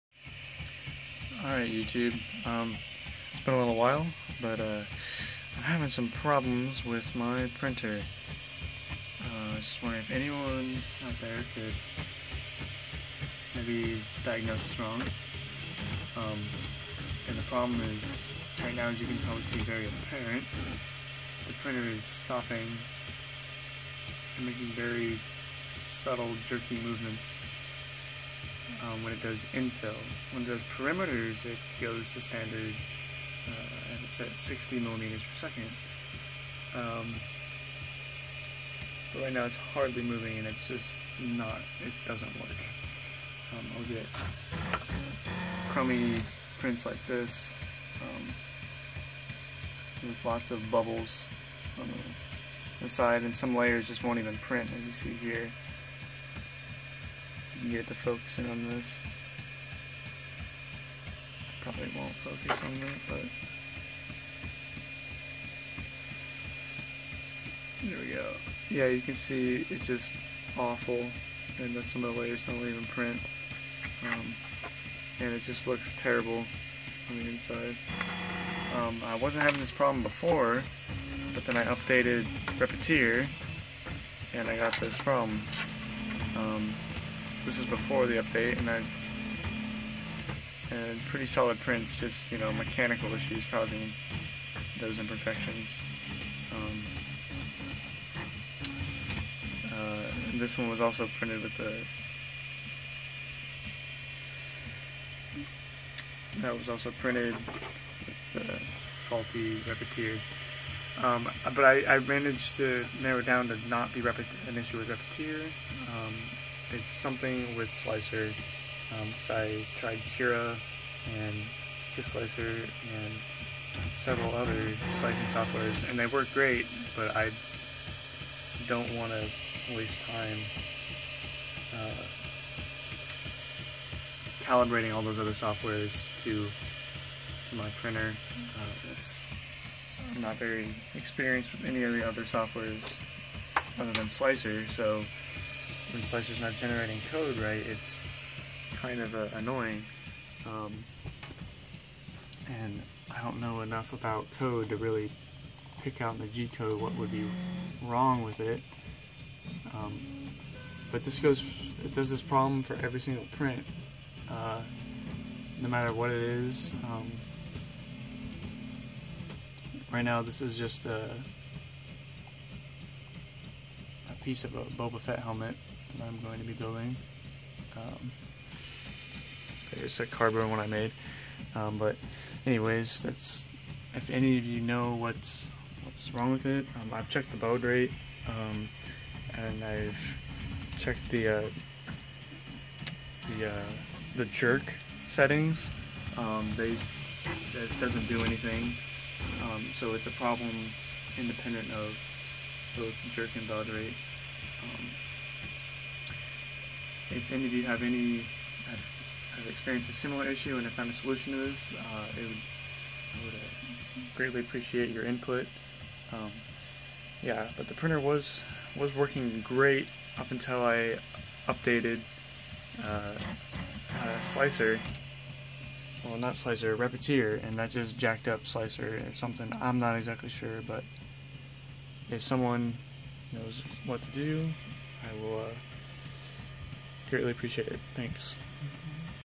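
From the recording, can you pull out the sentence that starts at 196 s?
Um, they it doesn't do anything, um, so it's a problem independent of both jerk and baud rate.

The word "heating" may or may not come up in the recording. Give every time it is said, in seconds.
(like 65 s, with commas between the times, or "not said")
not said.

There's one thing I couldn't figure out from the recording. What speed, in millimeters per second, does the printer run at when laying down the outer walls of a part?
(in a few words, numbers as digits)
60 millimeters per second.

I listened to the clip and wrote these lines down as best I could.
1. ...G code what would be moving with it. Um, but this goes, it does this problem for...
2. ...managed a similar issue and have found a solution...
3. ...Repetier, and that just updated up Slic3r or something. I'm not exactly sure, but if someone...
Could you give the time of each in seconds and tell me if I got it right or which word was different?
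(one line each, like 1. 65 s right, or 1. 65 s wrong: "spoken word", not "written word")
1. 156 s wrong: "wrong", not "moving"
2. 209 s wrong: "experienced", not "managed"
3. 226 s wrong: "jacked", not "updated".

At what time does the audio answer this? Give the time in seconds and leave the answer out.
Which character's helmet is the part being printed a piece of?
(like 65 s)
174 s.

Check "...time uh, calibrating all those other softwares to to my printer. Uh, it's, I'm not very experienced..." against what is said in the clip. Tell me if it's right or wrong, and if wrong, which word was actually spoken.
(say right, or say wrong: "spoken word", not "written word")
right.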